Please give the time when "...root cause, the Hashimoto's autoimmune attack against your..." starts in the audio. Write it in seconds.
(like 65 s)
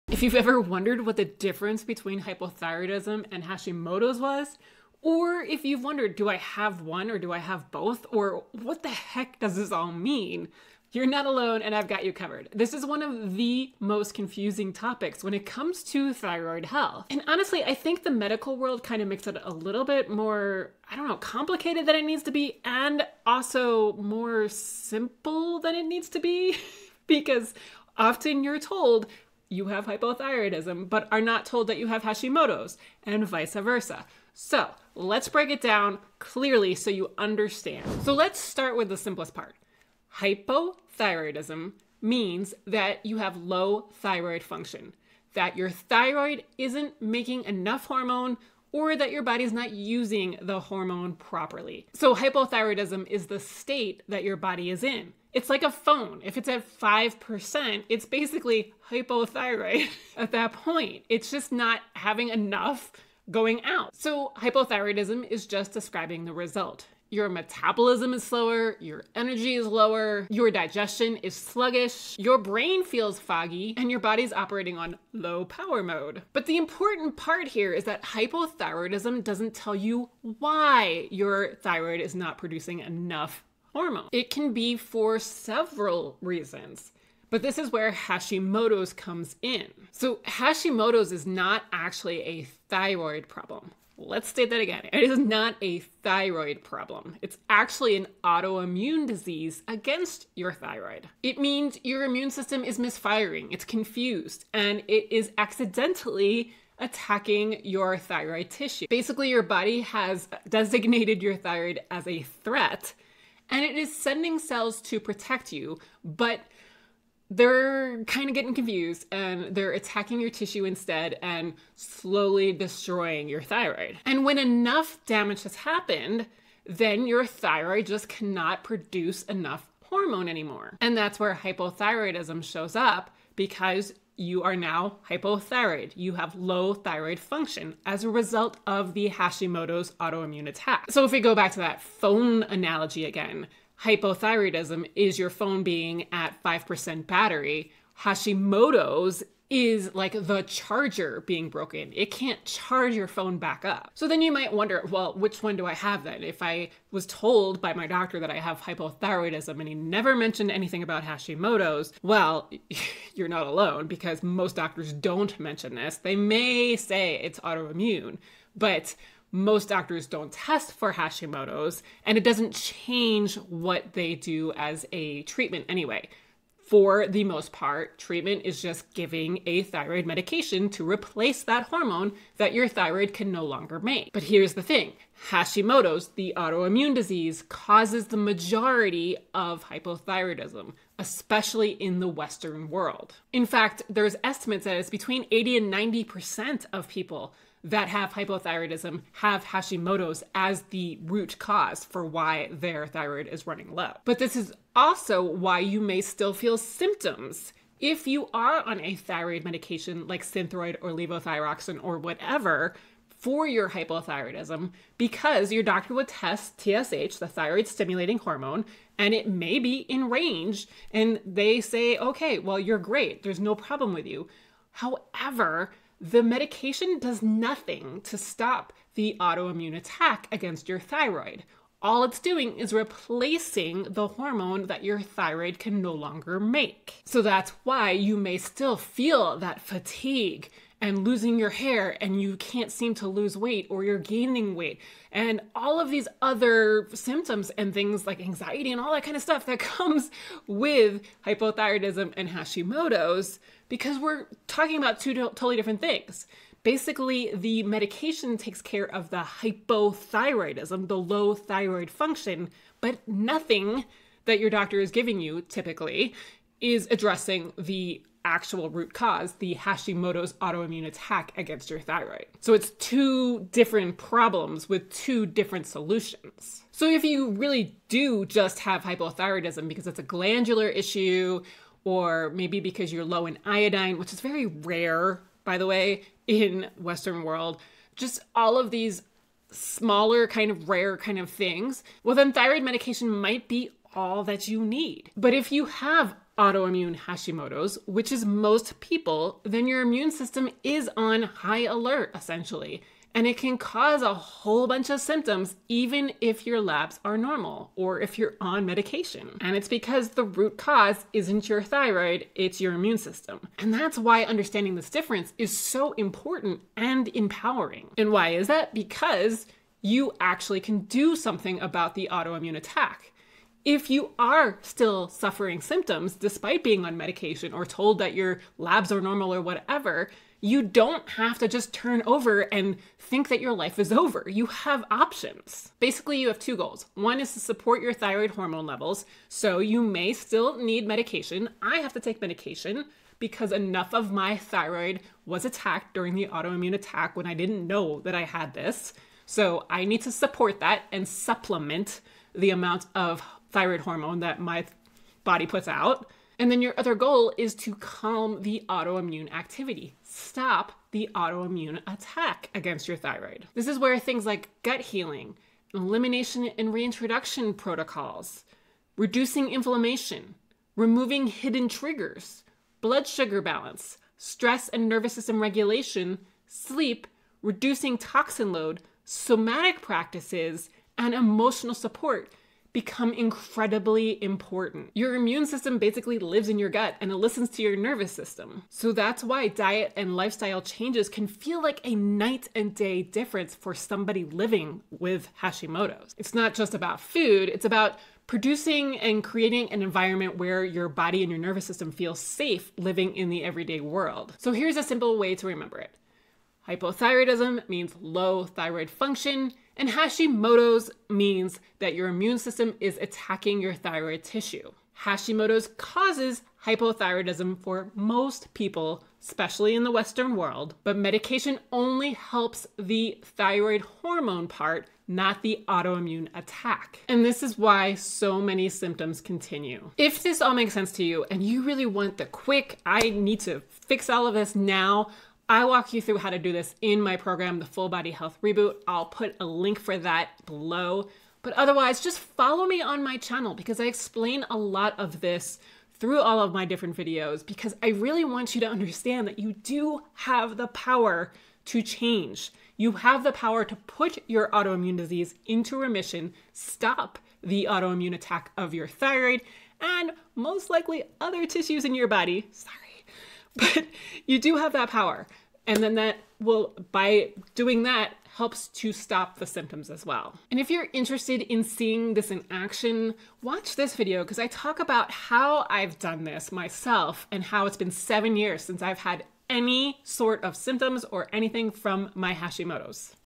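268 s.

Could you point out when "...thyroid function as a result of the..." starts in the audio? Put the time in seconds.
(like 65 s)
136 s.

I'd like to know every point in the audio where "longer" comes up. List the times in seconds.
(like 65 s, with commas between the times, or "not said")
183 s, 235 s.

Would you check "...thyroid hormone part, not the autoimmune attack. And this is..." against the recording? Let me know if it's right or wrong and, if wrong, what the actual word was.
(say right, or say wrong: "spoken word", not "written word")
right.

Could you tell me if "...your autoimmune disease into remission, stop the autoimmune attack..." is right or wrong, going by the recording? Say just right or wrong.
right.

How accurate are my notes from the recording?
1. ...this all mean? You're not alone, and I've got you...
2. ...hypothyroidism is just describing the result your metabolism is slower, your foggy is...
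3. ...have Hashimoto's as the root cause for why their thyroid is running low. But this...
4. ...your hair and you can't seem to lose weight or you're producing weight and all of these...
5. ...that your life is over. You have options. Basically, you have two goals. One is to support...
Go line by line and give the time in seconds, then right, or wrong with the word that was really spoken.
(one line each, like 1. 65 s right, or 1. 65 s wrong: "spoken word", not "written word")
1. 9 s right
2. 64 s wrong: "energy", not "foggy"
3. 199 s right
4. 241 s wrong: "gaining", not "producing"
5. 333 s right.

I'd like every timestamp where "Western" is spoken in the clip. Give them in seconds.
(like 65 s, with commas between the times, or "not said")
192 s, 286 s, 419 s.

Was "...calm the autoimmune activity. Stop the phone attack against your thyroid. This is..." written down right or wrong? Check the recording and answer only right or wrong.
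wrong.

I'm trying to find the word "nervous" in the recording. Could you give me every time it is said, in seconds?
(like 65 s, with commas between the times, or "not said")
374 s, 387 s, 401 s.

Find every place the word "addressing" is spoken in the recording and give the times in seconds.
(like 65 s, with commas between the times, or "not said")
266 s.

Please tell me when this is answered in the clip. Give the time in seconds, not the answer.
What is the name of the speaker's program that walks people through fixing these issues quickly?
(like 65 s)
437 s.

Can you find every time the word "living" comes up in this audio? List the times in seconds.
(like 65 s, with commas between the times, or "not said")
394 s, 402 s.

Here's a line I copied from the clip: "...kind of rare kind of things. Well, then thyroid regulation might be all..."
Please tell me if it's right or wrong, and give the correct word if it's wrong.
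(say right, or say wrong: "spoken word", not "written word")
wrong: "medication", not "regulation".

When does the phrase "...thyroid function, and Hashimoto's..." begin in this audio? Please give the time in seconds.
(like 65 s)
408 s.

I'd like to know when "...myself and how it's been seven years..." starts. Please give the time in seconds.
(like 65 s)
476 s.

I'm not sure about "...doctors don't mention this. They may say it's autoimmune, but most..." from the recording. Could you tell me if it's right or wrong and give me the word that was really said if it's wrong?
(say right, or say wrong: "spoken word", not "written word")
right.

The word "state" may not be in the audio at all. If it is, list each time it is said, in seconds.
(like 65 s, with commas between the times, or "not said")
53 s, 94 s.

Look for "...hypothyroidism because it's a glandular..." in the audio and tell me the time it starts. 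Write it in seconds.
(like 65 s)
278 s.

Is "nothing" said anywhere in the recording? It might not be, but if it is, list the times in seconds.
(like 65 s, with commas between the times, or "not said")
227 s, 263 s.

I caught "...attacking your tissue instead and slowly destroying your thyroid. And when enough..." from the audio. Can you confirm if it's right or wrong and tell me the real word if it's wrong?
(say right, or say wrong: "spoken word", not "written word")
right.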